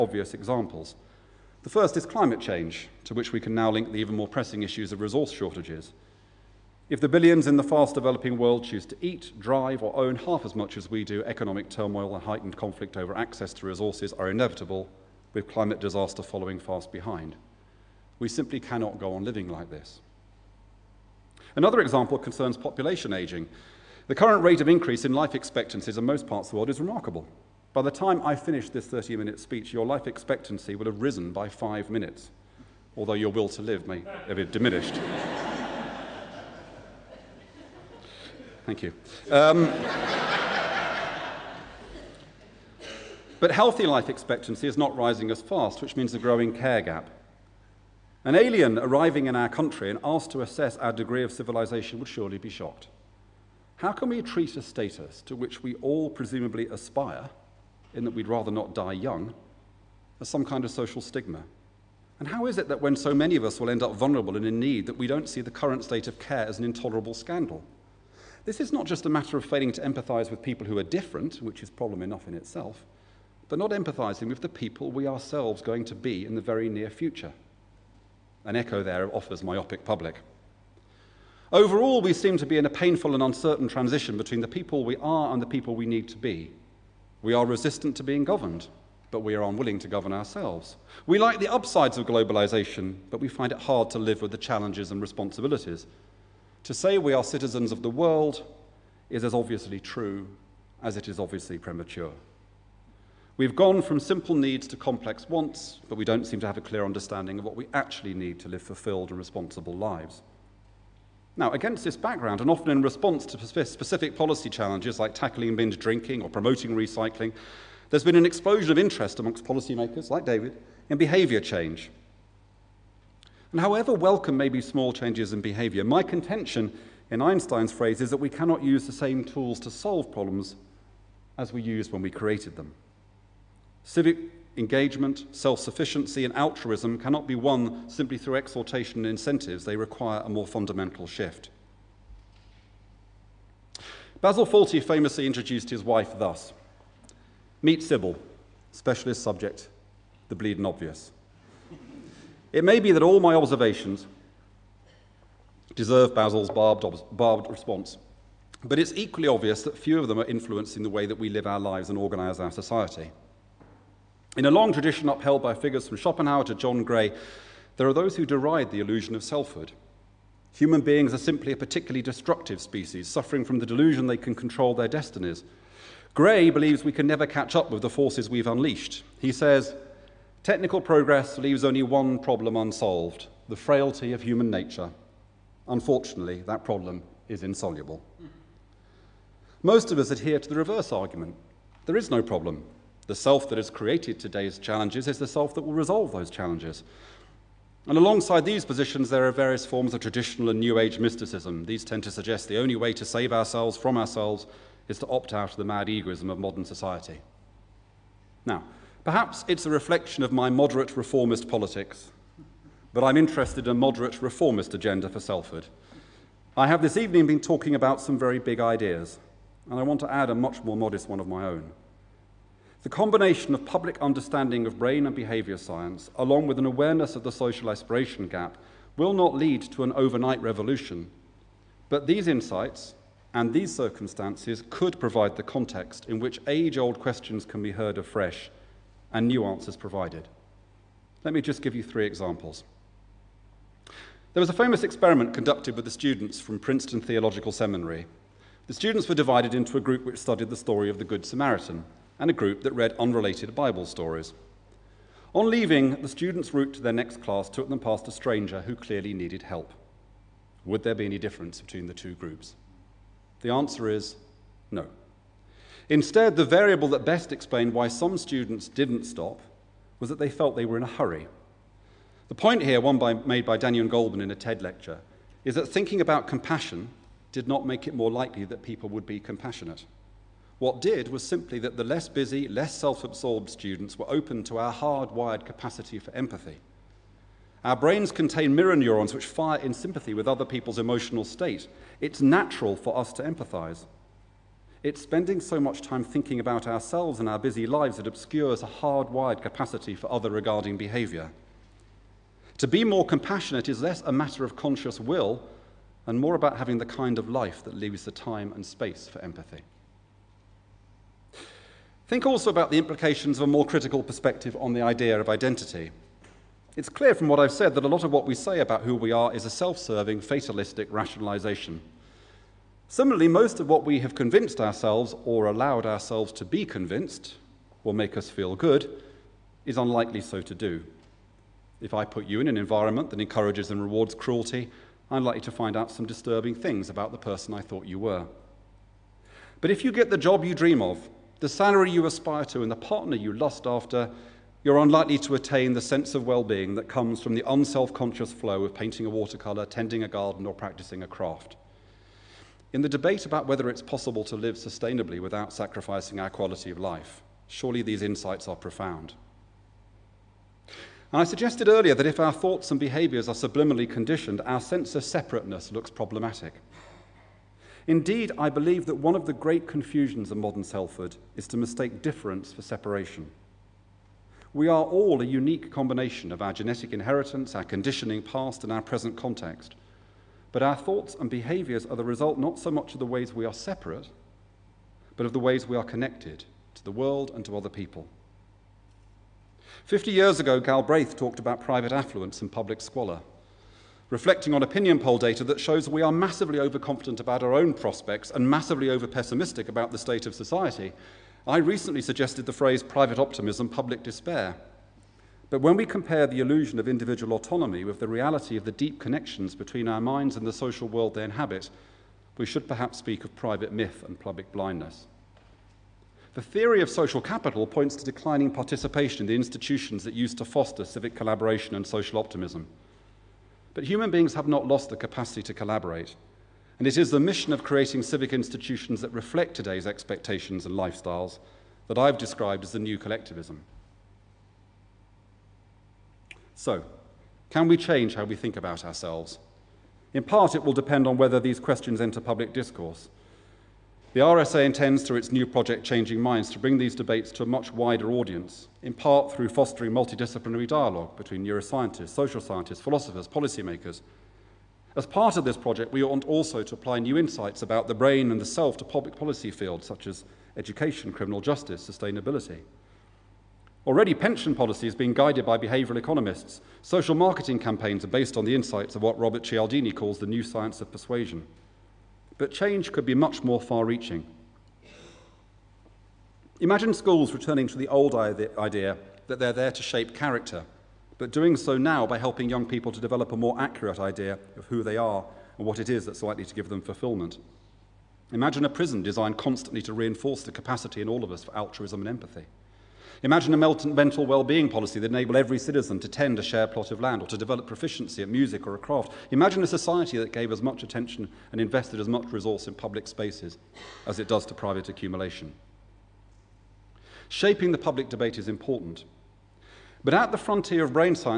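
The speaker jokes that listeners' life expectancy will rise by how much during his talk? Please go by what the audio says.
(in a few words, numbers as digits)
5 minutes.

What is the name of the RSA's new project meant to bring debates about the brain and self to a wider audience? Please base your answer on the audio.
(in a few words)
Changing Minds.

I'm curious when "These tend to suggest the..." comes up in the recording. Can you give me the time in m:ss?
3:21.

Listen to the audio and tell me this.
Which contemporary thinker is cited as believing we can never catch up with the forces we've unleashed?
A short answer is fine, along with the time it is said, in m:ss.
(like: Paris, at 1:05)
John Gray, at 2:46.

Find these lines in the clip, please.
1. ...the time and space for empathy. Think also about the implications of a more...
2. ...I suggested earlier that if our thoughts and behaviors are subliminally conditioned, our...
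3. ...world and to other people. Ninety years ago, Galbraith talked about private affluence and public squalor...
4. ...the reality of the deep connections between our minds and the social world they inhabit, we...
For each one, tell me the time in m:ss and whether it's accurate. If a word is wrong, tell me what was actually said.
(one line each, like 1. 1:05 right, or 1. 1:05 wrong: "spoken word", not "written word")
1. 5:08 right
2. 6:01 right
3. 6:26 wrong: "Fifty", not "Ninety"
4. 6:47 right.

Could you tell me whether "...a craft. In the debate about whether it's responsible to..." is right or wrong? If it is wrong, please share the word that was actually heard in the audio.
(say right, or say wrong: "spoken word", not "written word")
wrong: "possible", not "responsible".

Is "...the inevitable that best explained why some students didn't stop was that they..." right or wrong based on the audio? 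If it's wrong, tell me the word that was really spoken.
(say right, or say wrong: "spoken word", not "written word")
wrong: "variable", not "inevitable".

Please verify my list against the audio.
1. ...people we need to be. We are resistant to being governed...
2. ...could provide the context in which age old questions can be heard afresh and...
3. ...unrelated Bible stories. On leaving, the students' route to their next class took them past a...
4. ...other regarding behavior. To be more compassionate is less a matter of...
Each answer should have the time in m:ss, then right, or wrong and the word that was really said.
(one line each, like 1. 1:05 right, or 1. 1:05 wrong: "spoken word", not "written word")
1. 1:25 right
2. 3:54 right
3. 4:12 right
4. 5:00 right.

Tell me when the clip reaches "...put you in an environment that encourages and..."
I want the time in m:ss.
5:32.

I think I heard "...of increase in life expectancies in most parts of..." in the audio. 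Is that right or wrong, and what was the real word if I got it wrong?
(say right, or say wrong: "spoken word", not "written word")
right.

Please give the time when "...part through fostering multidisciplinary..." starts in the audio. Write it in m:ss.
7:28.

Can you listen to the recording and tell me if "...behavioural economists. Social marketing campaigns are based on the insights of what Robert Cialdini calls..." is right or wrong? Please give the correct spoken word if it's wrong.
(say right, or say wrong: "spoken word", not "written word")
right.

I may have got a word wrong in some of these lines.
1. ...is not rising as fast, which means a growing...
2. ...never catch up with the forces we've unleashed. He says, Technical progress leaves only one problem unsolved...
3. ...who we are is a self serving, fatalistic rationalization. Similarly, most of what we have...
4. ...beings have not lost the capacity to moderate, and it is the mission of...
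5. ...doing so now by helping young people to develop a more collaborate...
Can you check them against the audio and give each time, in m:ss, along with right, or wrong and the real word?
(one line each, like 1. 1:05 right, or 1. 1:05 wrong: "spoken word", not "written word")
1. 0:44 right
2. 2:57 right
3. 5:18 right
4. 7:04 wrong: "collaborate", not "moderate"
5. 8:01 wrong: "accurate", not "collaborate".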